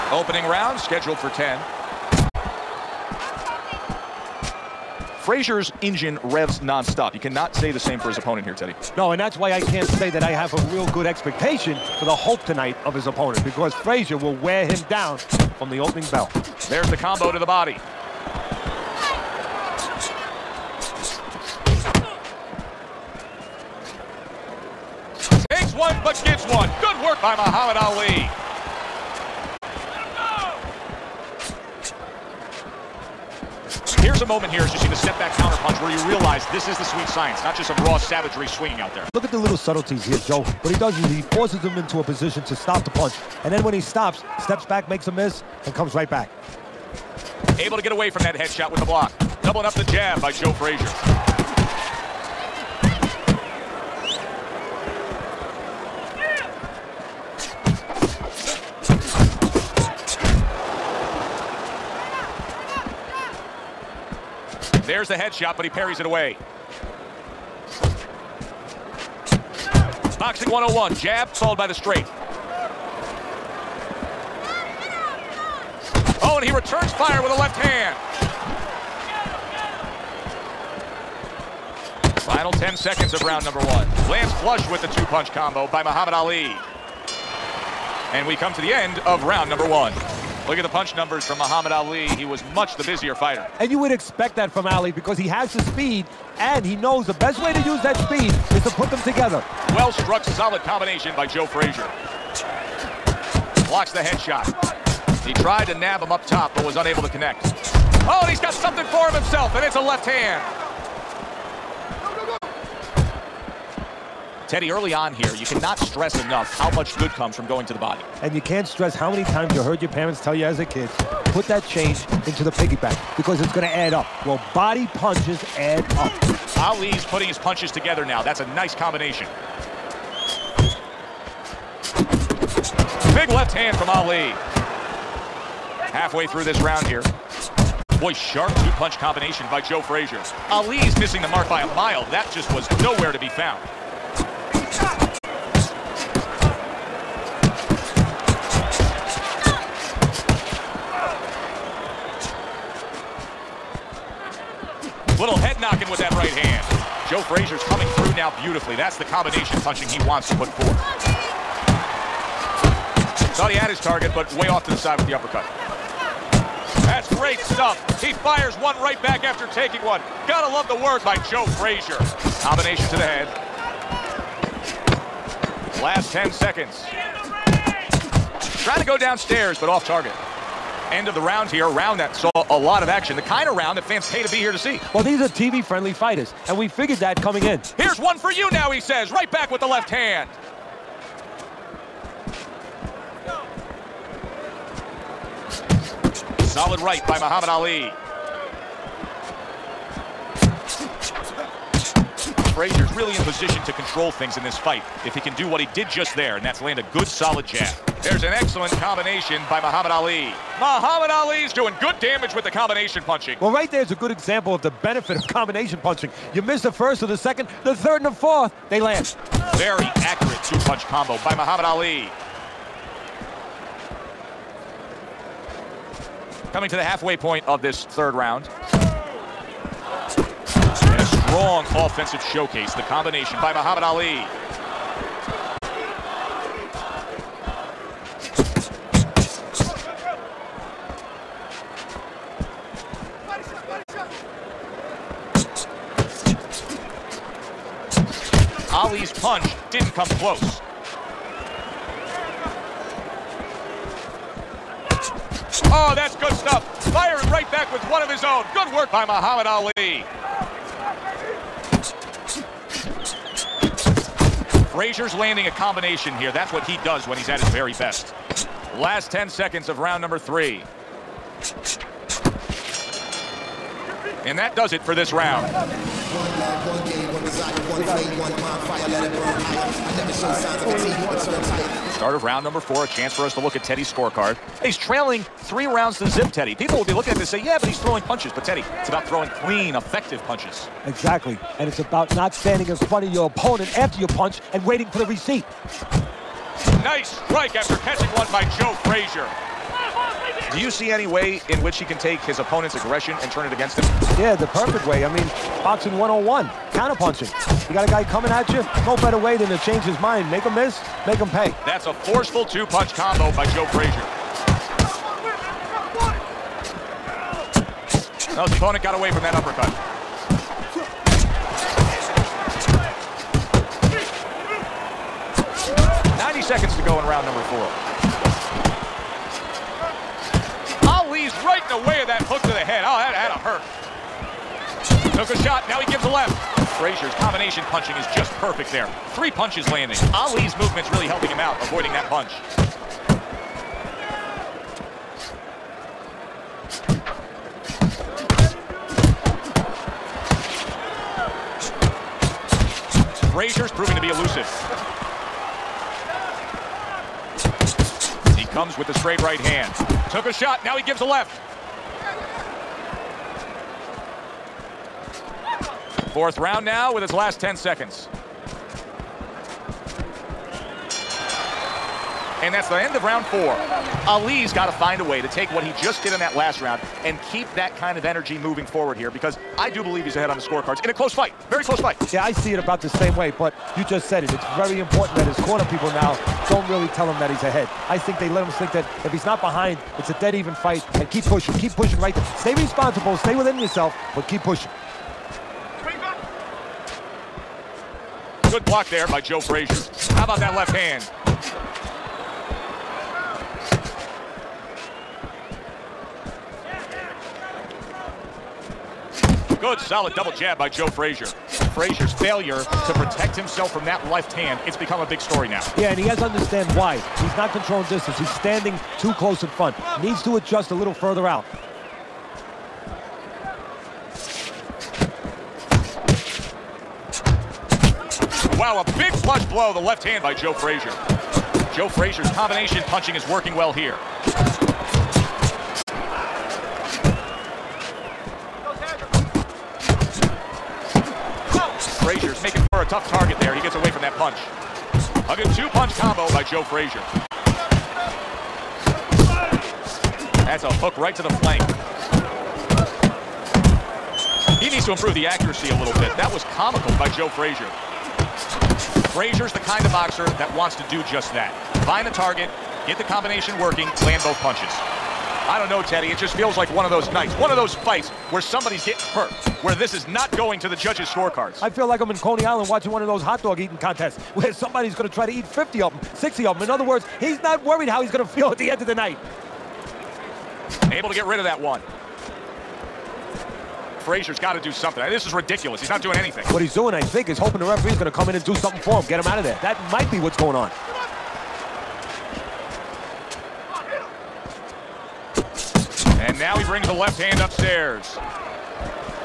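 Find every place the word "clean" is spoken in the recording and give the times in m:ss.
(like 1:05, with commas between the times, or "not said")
4:49.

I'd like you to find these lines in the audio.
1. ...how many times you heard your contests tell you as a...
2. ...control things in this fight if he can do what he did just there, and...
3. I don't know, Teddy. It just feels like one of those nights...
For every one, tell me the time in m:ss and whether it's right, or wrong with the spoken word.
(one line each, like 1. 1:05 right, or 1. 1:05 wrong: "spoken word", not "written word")
1. 1:58 wrong: "parents", not "contests"
2. 3:23 right
3. 7:45 right.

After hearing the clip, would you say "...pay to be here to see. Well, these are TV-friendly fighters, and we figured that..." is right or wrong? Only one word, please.
right.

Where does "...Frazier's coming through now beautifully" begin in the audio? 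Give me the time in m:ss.
2:37.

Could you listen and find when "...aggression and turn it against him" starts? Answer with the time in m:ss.
5:02.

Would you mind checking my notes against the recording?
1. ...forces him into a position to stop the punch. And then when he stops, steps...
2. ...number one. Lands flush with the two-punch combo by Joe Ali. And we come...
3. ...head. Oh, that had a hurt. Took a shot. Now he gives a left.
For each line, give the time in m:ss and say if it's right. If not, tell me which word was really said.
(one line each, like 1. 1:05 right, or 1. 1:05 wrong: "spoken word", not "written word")
1. 0:41 right
2. 1:23 wrong: "Muhammad", not "Joe"
3. 5:32 right.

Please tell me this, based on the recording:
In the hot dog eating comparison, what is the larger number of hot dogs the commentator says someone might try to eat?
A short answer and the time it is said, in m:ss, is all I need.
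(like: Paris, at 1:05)
60, at 7:56.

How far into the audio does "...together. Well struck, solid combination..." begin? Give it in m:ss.
1:39.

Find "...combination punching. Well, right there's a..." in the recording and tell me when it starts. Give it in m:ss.
3:32.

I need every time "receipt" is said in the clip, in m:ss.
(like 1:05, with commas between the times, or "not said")
4:55.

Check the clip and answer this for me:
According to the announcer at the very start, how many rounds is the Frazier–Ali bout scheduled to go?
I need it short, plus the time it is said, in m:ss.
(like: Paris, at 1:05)
10, at 0:00.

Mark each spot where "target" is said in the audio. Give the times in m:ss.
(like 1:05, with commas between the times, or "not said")
2:43, 2:59, 7:23, 7:42.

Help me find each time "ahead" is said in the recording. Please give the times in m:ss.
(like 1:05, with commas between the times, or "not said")
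6:20, 6:27.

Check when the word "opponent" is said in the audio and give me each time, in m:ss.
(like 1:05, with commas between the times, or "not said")
0:08, 0:13, 4:53, 5:02, 5:18.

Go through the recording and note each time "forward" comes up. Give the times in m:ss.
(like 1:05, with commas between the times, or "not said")
6:18.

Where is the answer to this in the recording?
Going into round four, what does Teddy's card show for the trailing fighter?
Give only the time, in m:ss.
4:45.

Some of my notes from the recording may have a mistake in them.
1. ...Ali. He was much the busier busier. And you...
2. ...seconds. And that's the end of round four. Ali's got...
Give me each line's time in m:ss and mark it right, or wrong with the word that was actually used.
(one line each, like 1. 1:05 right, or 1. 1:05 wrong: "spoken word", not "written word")
1. 1:31 wrong: "fighter", not "busier"
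2. 6:07 right.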